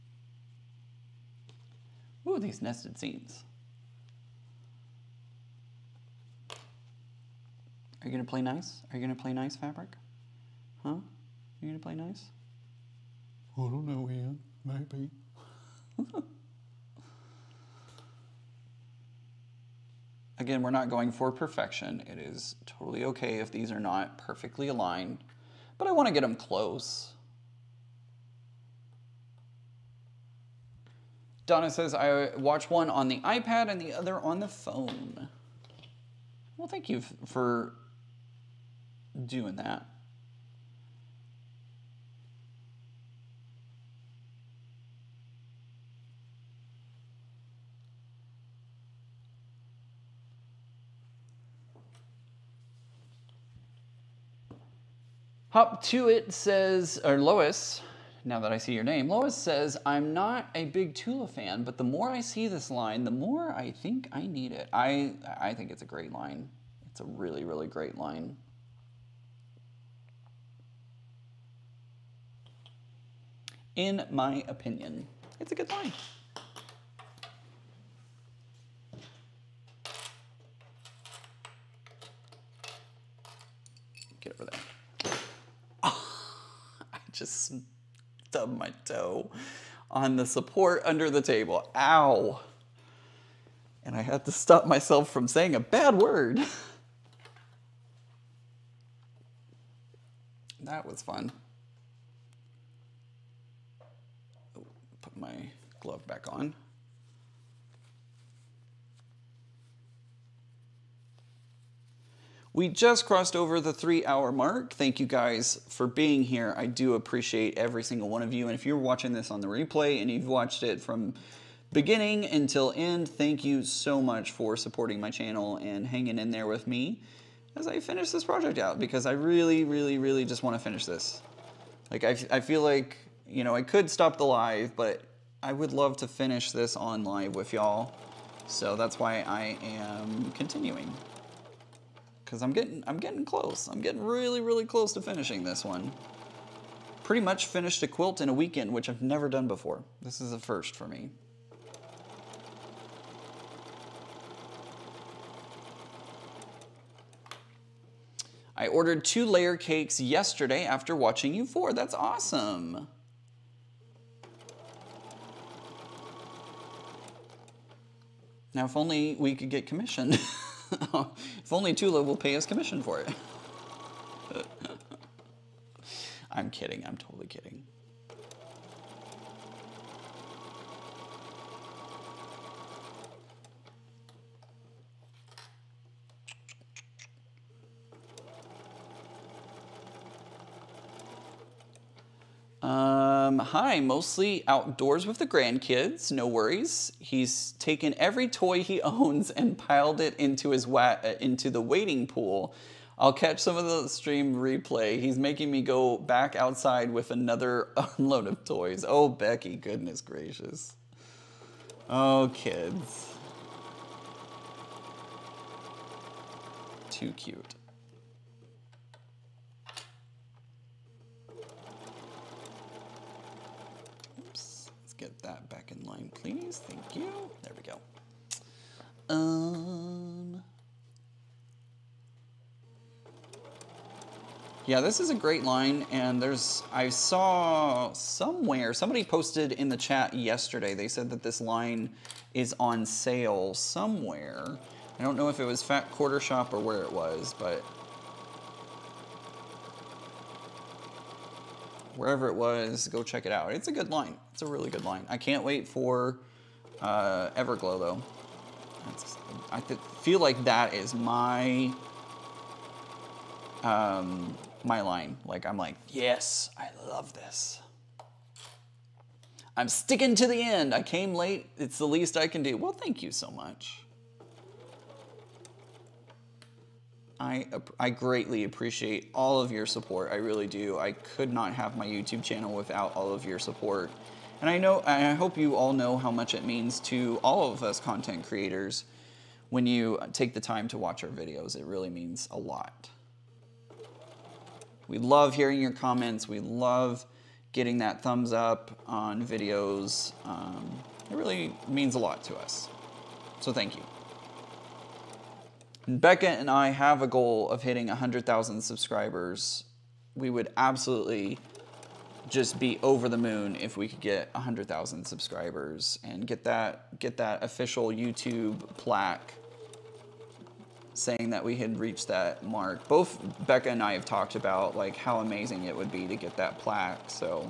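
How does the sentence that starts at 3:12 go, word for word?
Um, hi, mostly outdoors with the grandkids, no worries.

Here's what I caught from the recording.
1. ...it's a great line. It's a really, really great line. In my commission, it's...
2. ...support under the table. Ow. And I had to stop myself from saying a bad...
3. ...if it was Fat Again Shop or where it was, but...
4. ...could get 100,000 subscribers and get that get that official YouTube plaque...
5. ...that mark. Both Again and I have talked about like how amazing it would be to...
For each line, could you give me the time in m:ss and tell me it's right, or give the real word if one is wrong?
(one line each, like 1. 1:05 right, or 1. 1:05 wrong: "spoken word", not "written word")
1. 1:05 wrong: "opinion", not "commission"
2. 1:30 right
3. 4:05 wrong: "Quarter", not "Again"
4. 5:13 right
5. 5:22 wrong: "Becca", not "Again".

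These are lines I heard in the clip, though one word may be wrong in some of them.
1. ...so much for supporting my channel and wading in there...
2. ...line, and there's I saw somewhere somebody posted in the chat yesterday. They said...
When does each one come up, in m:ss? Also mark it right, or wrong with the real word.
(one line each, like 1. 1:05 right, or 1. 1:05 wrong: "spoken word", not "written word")
1. 2:03 wrong: "hanging", not "wading"
2. 3:55 right.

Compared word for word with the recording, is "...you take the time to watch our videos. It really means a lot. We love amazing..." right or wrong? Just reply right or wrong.
wrong.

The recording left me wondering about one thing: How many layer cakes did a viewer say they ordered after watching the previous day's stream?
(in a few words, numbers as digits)
2.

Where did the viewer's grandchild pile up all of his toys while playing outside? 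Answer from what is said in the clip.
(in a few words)
wading pool.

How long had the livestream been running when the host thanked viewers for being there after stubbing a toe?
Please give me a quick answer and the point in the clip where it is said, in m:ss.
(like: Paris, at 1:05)
3 hours, at 1:53.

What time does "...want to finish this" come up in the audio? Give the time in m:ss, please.
2:10.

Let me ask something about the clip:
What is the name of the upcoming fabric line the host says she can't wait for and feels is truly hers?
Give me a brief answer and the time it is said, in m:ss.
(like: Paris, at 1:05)
Everglow, at 4:17.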